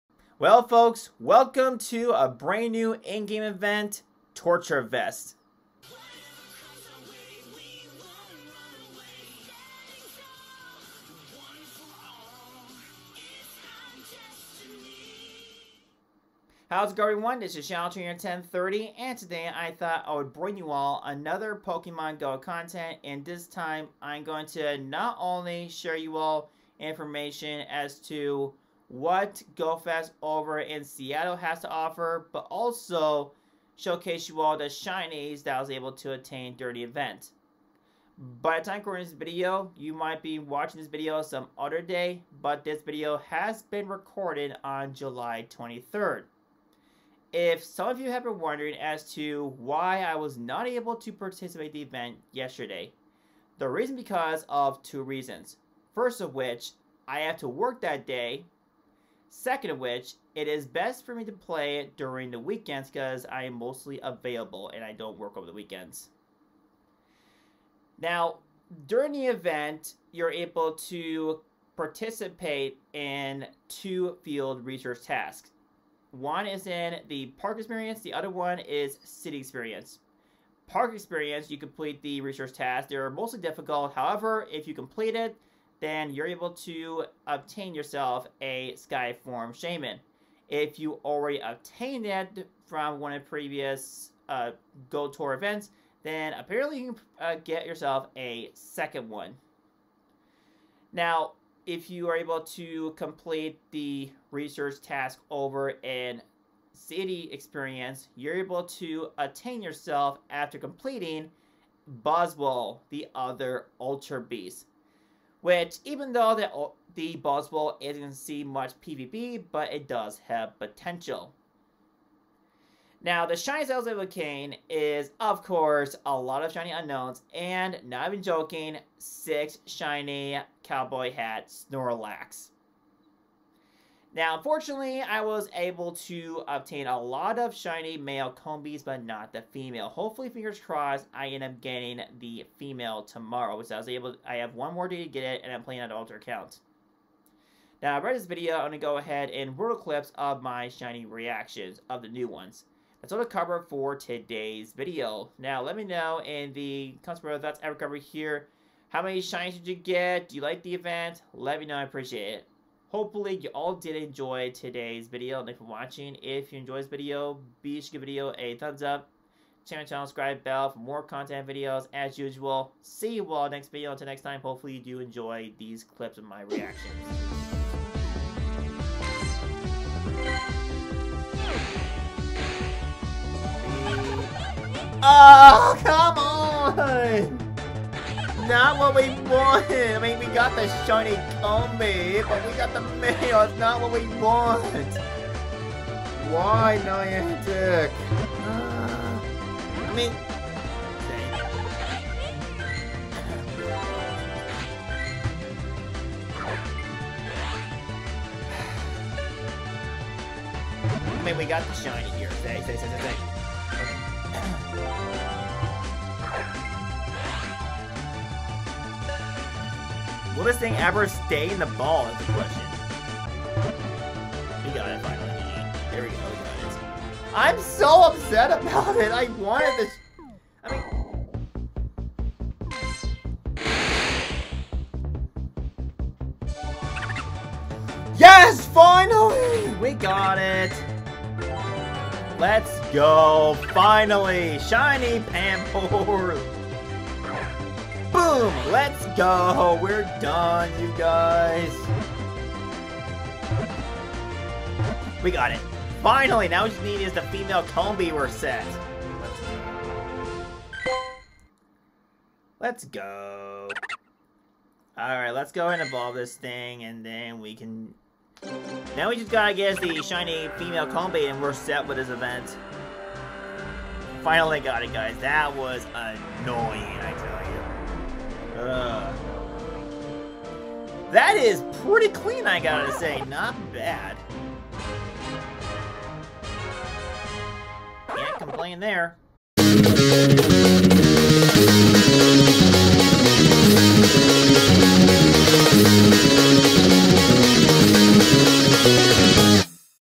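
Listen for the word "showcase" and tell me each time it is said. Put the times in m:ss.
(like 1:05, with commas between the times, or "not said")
0:33.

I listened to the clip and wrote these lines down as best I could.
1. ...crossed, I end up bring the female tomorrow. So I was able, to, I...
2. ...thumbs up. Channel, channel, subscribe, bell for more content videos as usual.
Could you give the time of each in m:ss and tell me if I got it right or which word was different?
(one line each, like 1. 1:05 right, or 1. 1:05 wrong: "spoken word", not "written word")
1. 2:20 wrong: "getting", not "bring"
2. 2:48 right.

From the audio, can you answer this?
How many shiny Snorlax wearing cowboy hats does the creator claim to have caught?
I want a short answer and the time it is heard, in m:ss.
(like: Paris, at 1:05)
6, at 2:08.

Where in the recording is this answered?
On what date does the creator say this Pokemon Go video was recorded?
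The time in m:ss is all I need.
0:44.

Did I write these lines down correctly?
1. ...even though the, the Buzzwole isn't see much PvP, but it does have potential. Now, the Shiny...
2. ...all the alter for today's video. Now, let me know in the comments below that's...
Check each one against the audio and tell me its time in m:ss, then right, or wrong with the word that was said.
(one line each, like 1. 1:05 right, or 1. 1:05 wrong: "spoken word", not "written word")
1. 1:55 right
2. 2:33 wrong: "cover", not "alter".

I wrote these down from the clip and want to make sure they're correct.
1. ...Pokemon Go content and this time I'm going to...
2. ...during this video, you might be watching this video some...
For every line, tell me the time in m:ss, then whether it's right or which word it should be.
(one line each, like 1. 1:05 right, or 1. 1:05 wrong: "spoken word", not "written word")
1. 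0:21 right
2. 0:38 wrong: "recording", not "during".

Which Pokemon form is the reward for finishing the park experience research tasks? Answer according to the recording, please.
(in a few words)
Skyform Shaymin.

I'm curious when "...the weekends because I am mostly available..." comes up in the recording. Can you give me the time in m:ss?
1:02.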